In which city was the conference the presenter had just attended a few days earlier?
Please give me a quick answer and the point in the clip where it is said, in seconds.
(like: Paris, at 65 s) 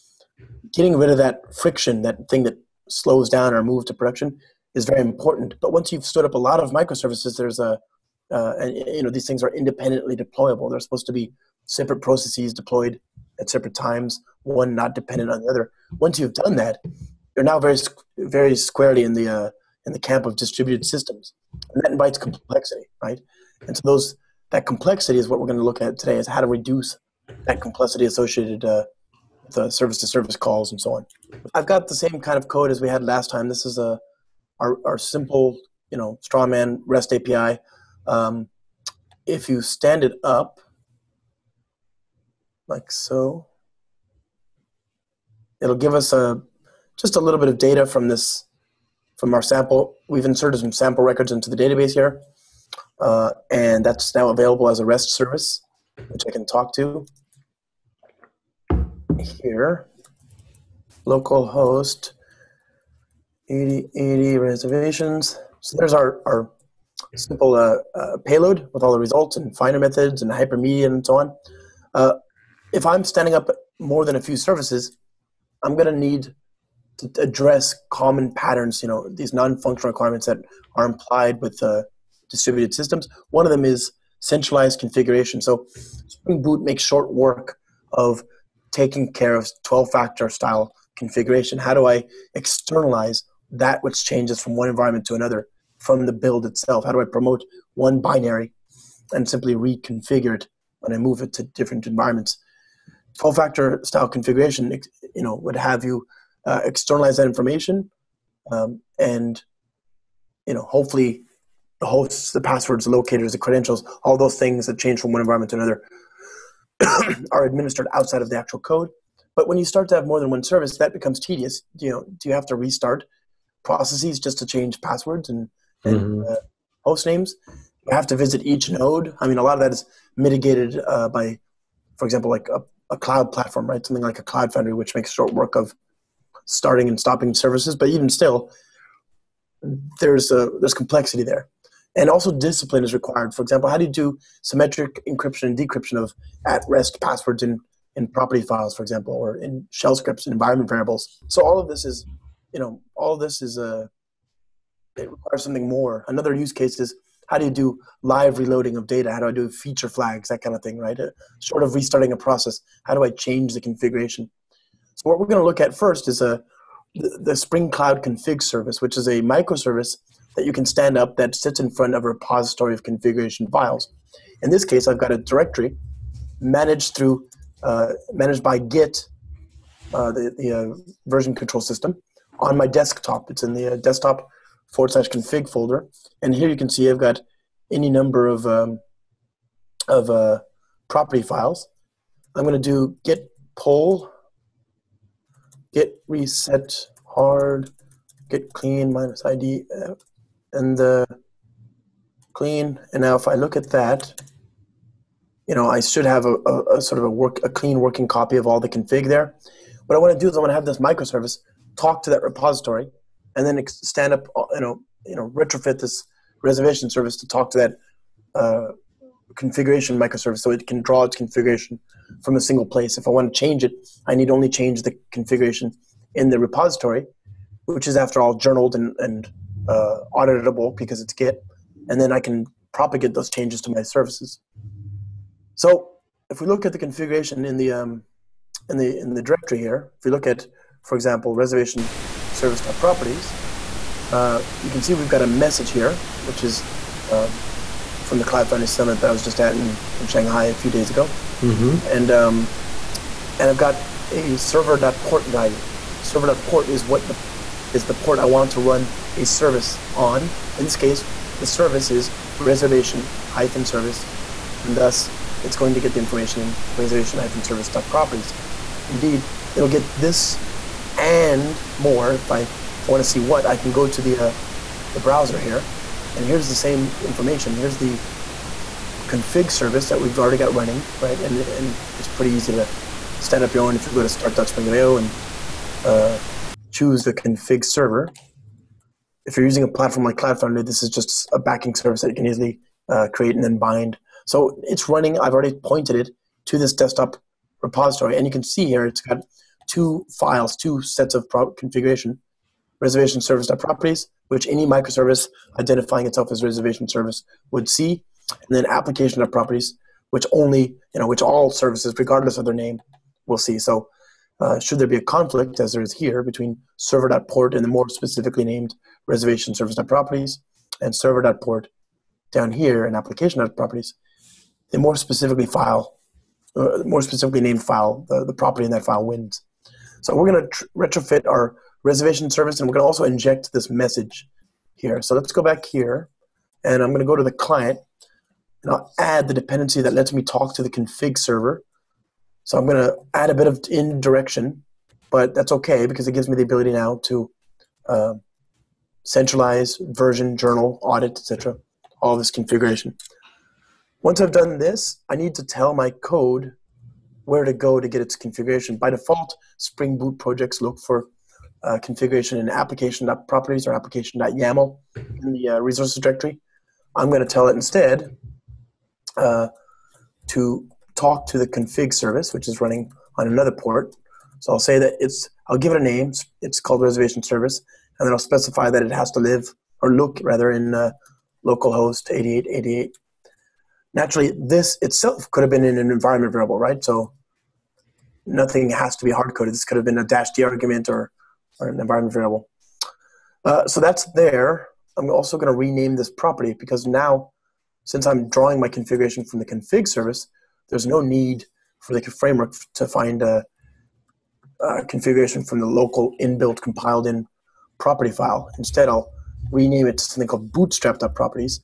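Shanghai, at 250 s.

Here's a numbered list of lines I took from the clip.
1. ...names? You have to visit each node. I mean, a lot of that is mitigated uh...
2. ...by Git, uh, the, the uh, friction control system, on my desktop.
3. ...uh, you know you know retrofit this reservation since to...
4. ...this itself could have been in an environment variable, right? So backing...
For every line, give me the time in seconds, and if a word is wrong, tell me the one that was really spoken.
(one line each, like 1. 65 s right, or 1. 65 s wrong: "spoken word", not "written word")
1. 127 s right
2. 178 s wrong: "version", not "friction"
3. 214 s wrong: "service", not "since"
4. 384 s wrong: "nothing", not "backing".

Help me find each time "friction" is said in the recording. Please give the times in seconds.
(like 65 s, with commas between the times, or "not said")
1 s.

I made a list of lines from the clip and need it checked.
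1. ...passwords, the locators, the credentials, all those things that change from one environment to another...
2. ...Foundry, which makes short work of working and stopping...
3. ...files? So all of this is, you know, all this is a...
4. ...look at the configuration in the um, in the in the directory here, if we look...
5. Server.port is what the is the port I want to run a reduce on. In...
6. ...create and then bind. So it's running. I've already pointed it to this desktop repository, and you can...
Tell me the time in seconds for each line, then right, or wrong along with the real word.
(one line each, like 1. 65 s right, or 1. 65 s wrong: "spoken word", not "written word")
1. 112 s right
2. 134 s wrong: "starting", not "working"
3. 150 s wrong: "variables", not "files"
4. 236 s right
5. 256 s wrong: "service", not "reduce"
6. 293 s right.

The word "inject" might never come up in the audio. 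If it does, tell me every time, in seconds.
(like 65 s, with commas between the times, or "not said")
333 s.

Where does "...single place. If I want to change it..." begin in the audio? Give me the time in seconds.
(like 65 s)
222 s.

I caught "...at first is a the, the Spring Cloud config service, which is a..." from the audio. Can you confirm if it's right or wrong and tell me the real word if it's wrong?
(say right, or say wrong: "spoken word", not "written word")
right.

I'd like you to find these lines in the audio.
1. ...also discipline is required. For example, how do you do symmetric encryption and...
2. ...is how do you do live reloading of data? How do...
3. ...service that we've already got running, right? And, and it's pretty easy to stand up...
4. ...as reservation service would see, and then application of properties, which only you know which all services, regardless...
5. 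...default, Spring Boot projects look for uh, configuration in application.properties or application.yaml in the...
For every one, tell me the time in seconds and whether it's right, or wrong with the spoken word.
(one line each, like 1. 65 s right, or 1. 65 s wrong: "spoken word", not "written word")
1. 142 s right
2. 156 s right
3. 279 s right
4. 306 s right
5. 358 s right.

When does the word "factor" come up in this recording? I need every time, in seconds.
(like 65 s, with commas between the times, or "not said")
89 s, 103 s.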